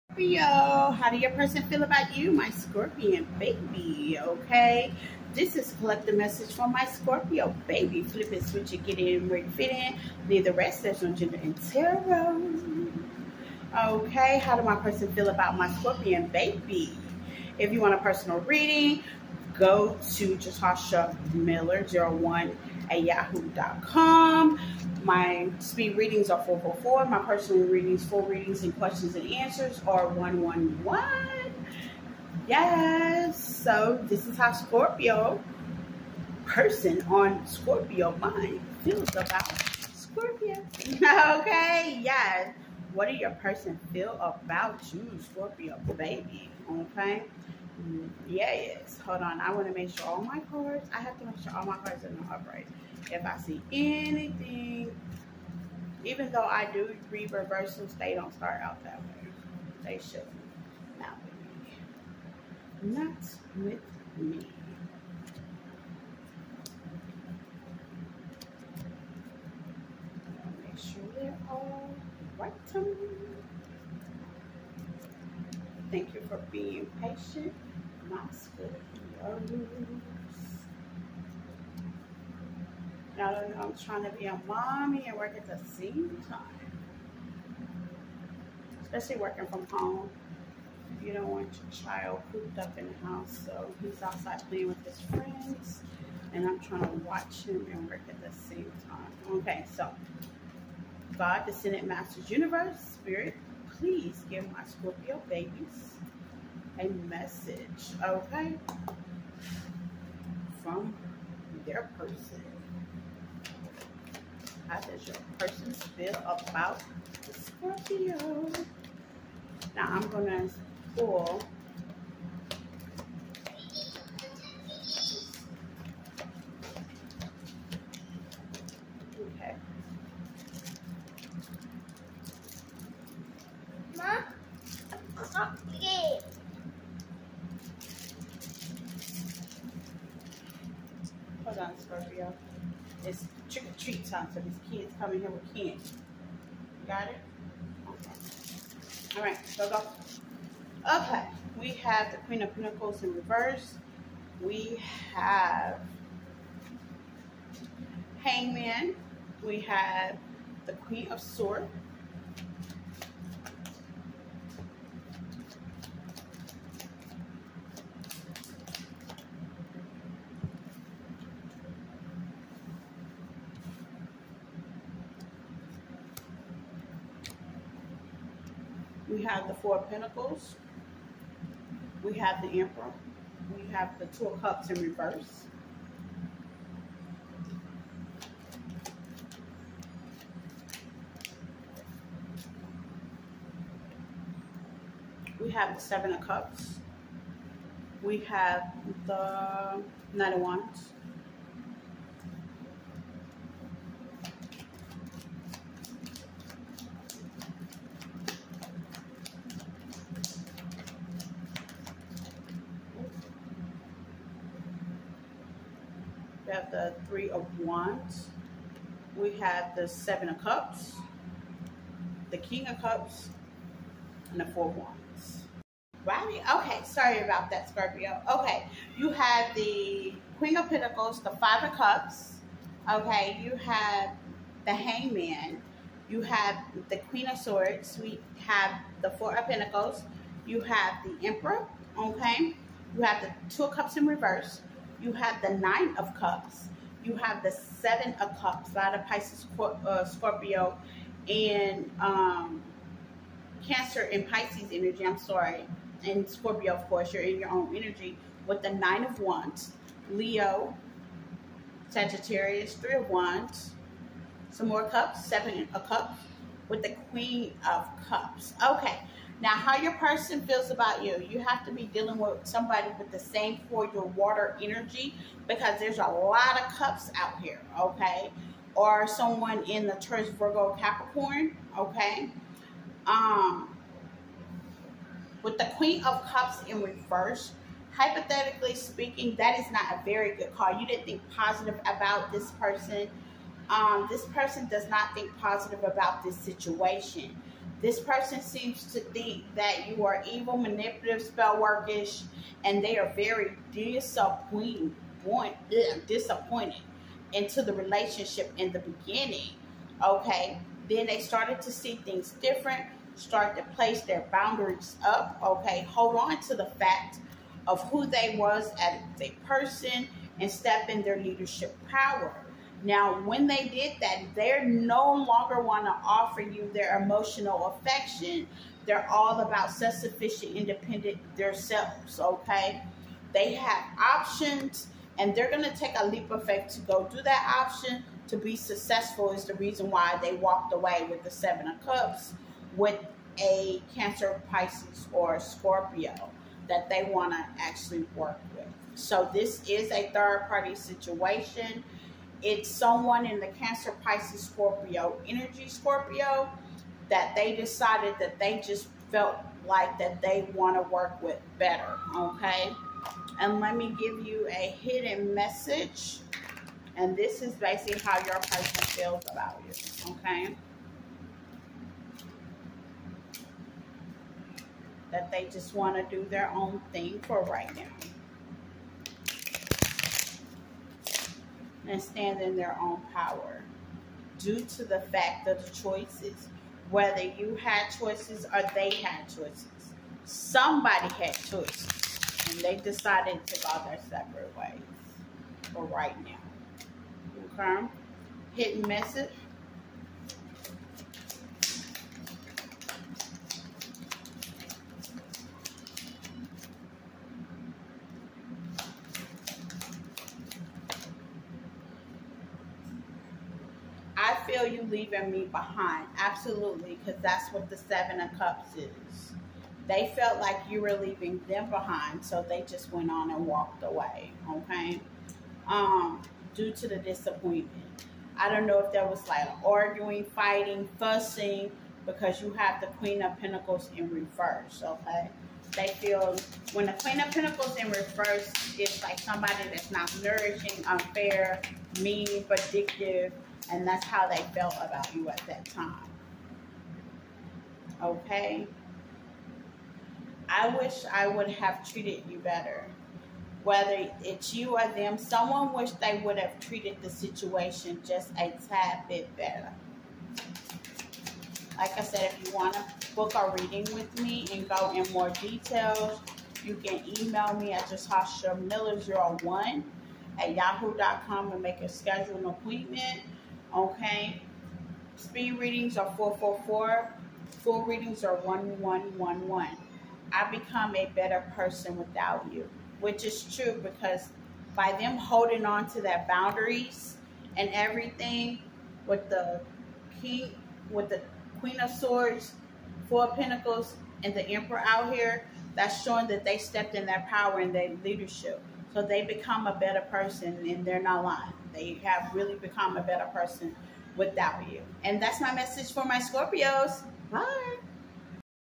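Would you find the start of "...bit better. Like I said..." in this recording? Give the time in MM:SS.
07:39.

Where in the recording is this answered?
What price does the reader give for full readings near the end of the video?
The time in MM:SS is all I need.
07:58.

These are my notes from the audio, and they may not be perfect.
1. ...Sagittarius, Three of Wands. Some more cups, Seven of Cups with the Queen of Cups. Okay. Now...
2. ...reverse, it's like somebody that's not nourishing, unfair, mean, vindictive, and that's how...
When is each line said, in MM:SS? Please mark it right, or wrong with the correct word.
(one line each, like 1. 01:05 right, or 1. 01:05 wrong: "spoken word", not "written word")
1. 04:21 right
2. 07:17 right.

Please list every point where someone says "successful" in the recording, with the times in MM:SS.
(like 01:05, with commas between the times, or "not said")
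05:38.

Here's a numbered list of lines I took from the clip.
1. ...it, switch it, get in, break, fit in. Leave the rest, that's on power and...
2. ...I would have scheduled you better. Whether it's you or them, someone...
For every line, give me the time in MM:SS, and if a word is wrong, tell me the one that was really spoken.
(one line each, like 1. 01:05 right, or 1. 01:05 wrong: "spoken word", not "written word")
1. 00:08 wrong: "gender", not "power"
2. 07:31 wrong: "treated", not "scheduled".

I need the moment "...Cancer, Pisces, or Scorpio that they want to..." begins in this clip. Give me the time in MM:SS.
05:43.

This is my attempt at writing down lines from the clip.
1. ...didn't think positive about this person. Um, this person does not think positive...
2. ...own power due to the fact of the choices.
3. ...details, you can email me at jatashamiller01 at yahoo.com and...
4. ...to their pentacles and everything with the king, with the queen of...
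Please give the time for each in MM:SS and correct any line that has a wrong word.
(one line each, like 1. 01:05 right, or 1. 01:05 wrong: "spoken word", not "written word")
1. 04:50 right
2. 06:22 right
3. 07:45 right
4. 08:05 wrong: "boundaries", not "pentacles".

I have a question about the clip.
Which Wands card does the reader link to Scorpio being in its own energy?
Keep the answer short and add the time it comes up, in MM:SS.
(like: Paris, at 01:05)
Nine of Wands, at 04:18.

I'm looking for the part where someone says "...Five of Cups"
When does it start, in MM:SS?
03:51.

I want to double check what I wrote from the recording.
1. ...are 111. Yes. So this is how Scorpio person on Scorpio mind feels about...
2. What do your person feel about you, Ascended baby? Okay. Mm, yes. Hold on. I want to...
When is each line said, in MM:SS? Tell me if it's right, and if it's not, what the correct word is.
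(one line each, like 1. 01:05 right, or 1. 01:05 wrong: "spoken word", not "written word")
1. 00:29 right
2. 00:42 wrong: "Scorpio", not "Ascended".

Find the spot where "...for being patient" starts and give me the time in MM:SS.
01:16.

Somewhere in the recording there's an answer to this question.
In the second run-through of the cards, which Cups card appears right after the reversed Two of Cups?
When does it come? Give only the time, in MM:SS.
04:05.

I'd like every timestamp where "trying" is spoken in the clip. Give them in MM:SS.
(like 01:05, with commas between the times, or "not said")
01:23, 01:36.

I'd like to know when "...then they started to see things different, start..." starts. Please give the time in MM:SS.
05:10.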